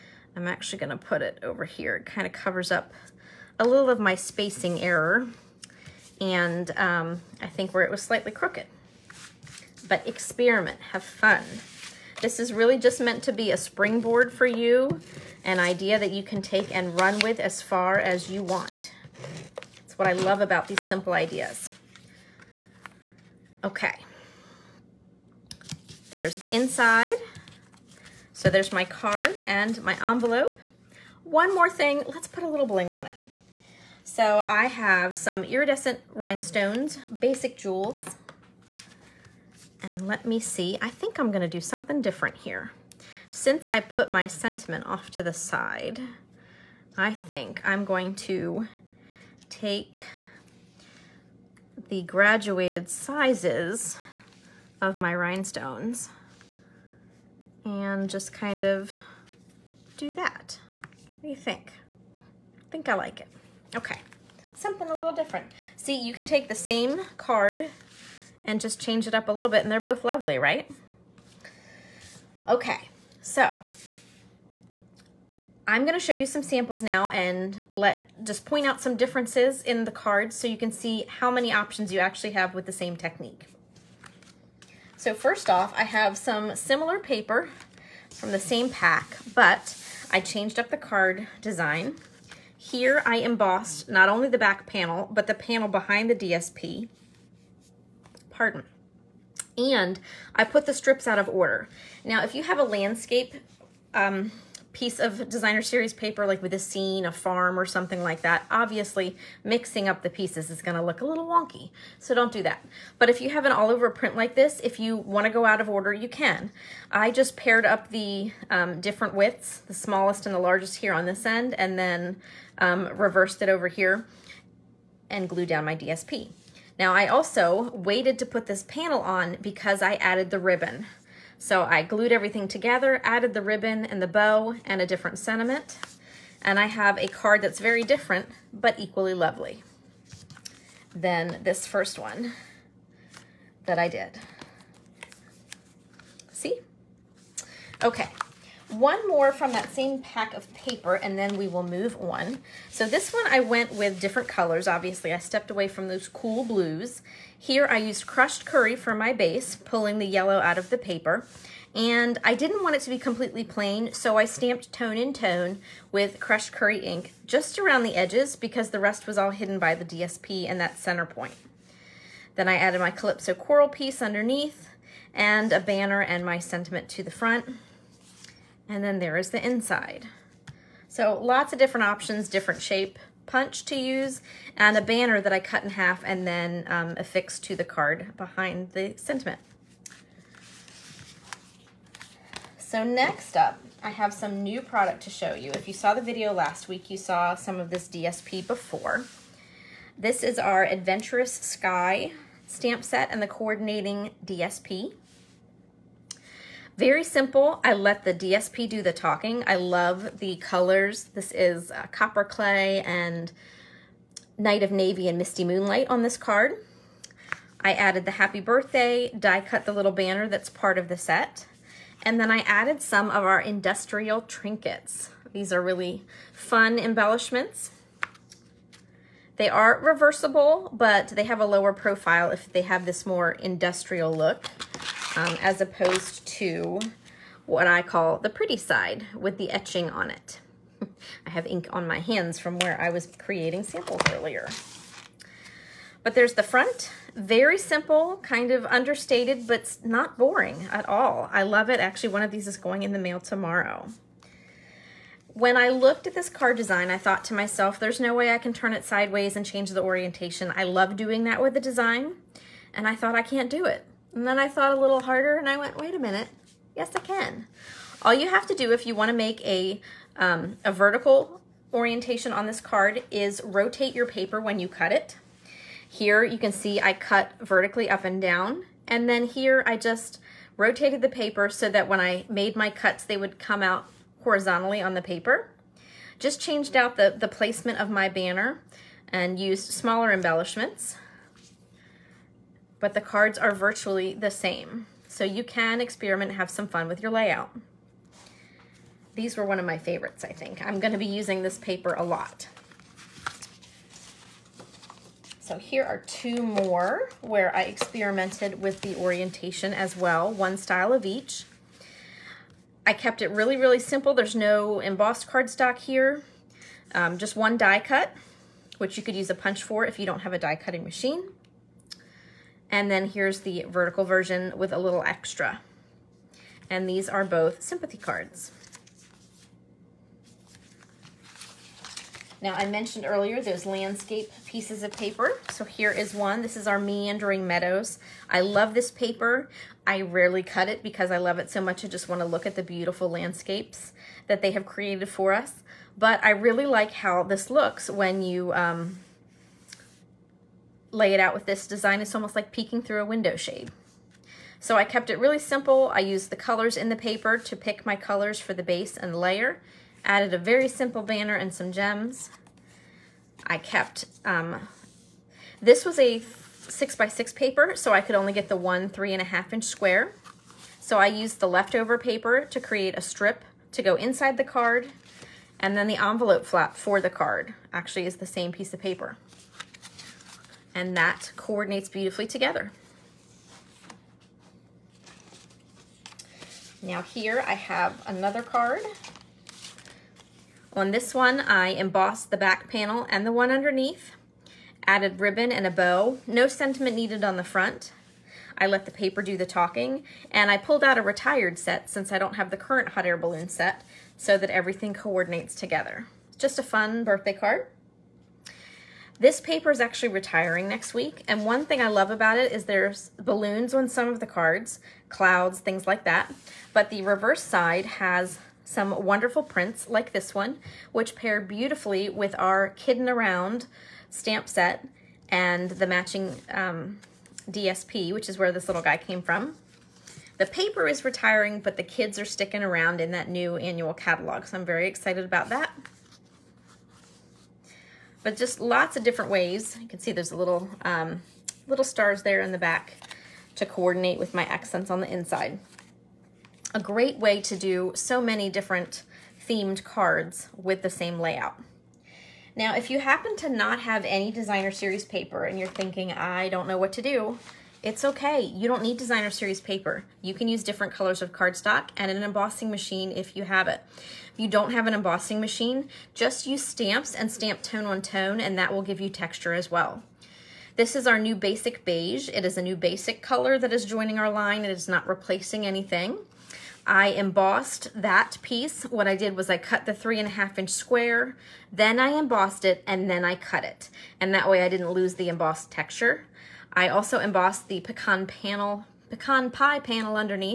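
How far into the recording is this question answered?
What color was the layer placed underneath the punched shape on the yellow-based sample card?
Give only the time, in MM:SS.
02:52.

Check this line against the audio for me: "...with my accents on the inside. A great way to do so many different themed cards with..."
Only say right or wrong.
right.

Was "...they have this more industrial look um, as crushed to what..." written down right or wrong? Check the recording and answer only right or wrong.
wrong.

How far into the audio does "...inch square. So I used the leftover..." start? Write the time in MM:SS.
06:09.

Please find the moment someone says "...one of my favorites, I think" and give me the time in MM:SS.
04:59.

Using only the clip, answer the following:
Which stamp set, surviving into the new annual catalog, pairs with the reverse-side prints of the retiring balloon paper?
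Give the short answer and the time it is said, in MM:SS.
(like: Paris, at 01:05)
Kiddin' Around, at 07:02.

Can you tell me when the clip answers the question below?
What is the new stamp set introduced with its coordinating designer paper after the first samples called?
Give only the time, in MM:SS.
03:20.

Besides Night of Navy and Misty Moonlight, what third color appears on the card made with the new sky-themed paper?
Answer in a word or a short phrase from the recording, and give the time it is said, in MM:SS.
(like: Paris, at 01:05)
Copper Clay, at 03:31.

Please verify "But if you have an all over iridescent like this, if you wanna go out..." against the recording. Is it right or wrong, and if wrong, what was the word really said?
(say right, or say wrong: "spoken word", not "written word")
wrong: "print", not "iridescent".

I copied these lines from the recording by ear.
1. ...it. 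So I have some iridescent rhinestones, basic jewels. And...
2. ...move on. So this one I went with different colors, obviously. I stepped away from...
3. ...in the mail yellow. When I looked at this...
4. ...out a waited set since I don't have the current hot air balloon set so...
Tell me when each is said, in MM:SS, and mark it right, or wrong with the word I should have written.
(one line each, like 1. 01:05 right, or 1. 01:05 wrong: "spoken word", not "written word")
1. 00:33 right
2. 02:31 right
3. 04:12 wrong: "tomorrow", not "yellow"
4. 06:40 wrong: "retired", not "waited".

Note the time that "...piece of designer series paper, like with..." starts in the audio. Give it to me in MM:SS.
01:44.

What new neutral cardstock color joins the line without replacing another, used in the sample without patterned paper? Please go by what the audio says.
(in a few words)
Basic Beige.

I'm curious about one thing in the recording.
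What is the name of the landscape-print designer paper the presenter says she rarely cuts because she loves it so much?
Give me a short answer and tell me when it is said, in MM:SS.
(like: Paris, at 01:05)
Meandering Meadows, at 05:36.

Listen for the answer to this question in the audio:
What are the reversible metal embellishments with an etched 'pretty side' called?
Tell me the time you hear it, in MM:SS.
03:43.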